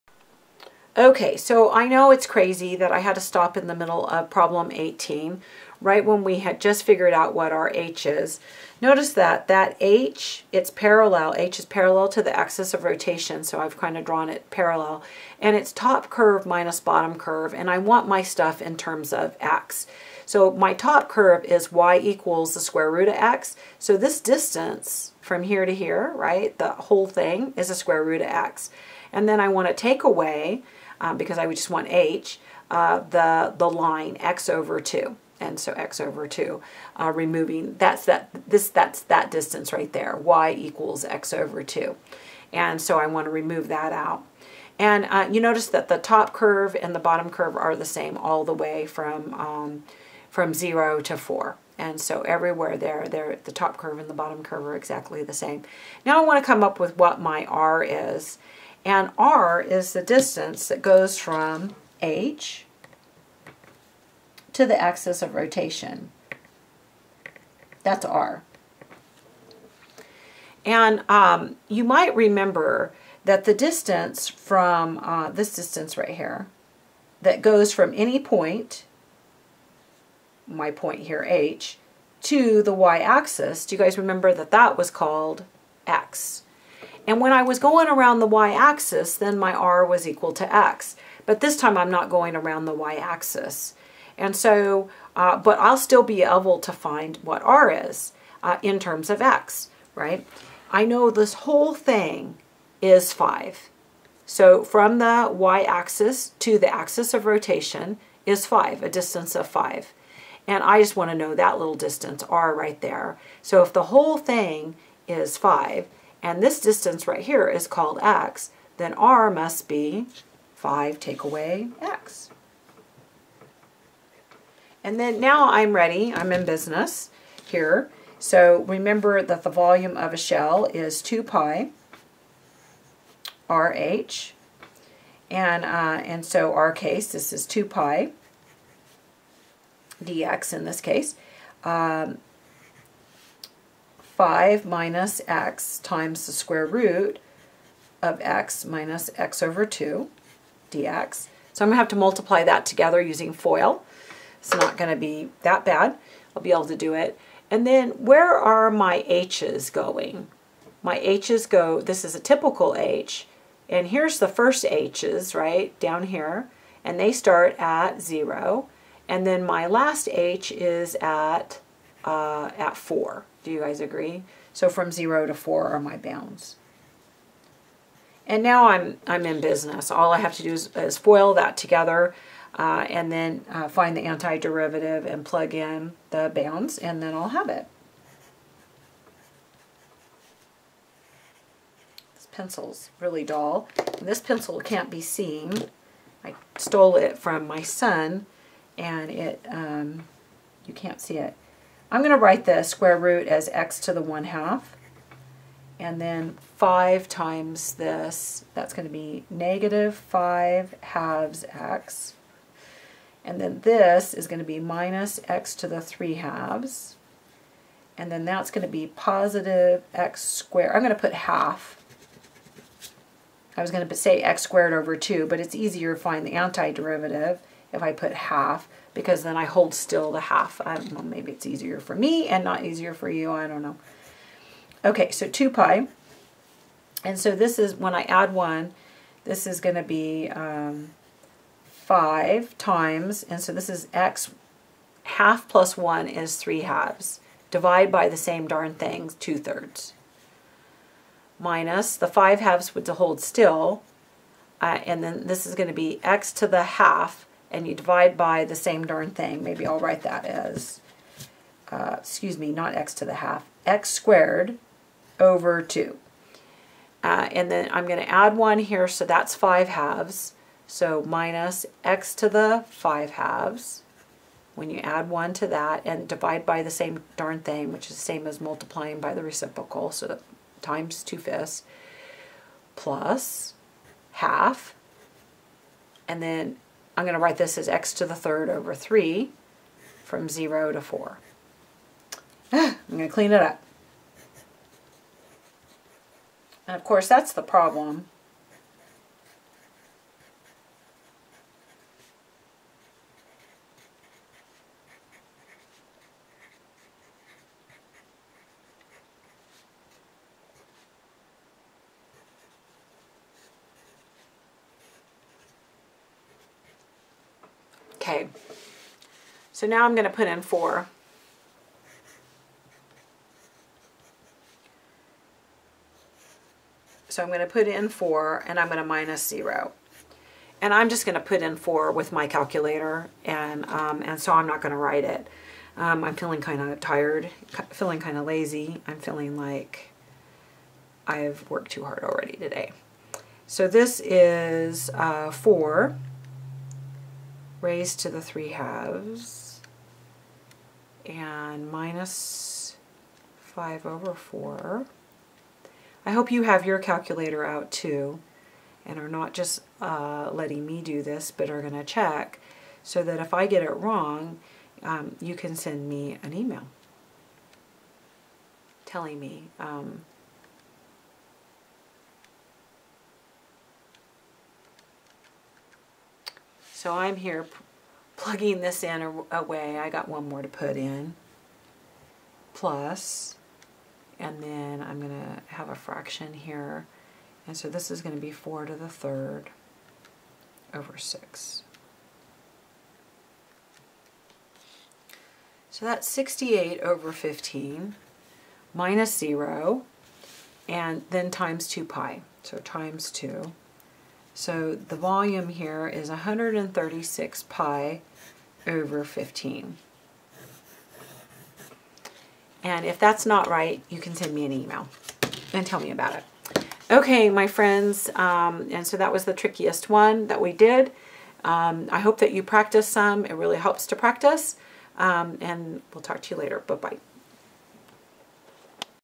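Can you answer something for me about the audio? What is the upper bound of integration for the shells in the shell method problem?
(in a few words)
4.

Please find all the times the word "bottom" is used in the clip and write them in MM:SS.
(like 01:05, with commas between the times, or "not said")
00:16, 00:46, 00:54.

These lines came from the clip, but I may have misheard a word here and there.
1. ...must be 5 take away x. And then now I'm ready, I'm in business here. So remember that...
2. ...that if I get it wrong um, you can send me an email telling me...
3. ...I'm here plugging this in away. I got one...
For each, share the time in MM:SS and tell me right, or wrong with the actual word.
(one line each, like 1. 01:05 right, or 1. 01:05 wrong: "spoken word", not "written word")
1. 01:59 right
2. 06:03 right
3. 06:16 right.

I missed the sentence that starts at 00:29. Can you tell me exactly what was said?
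And then I want to take away um, because I would just want h, uh, the, the line x over 2.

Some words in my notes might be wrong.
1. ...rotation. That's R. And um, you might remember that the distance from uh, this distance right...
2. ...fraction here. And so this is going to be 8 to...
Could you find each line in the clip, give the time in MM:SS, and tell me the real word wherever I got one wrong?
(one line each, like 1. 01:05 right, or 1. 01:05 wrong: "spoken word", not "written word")
1. 01:05 right
2. 06:25 wrong: "4", not "8".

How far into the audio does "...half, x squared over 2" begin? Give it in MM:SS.
04:23.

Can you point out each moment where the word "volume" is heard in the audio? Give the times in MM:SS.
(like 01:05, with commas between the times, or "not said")
02:09, 06:44.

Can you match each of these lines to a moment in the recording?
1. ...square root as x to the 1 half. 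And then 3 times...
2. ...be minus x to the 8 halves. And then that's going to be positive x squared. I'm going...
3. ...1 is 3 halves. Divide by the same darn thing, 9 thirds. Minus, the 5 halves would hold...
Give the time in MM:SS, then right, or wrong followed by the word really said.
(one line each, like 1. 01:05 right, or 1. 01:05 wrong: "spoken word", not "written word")
1. 03:22 wrong: "5", not "3"
2. 03:34 wrong: "3", not "8"
3. 04:05 wrong: "2", not "9".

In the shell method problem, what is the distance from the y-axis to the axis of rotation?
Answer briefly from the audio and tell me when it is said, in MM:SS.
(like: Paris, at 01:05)
5, at 01:48.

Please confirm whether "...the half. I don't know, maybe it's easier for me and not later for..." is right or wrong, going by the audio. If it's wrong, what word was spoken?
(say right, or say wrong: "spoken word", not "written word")
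wrong: "easier", not "later".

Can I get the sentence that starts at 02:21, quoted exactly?
Um, 5 minus x times the square root of x minus x over 2 dx.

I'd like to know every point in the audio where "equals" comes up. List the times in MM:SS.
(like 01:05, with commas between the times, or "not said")
00:21, 00:40, 01:30.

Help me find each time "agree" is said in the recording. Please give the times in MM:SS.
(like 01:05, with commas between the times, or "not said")
02:53.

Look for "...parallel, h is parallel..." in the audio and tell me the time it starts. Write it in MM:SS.
00:10.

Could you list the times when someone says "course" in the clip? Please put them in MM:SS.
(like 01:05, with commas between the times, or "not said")
04:56.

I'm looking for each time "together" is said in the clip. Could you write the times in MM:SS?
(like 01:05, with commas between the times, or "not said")
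02:32, 03:01.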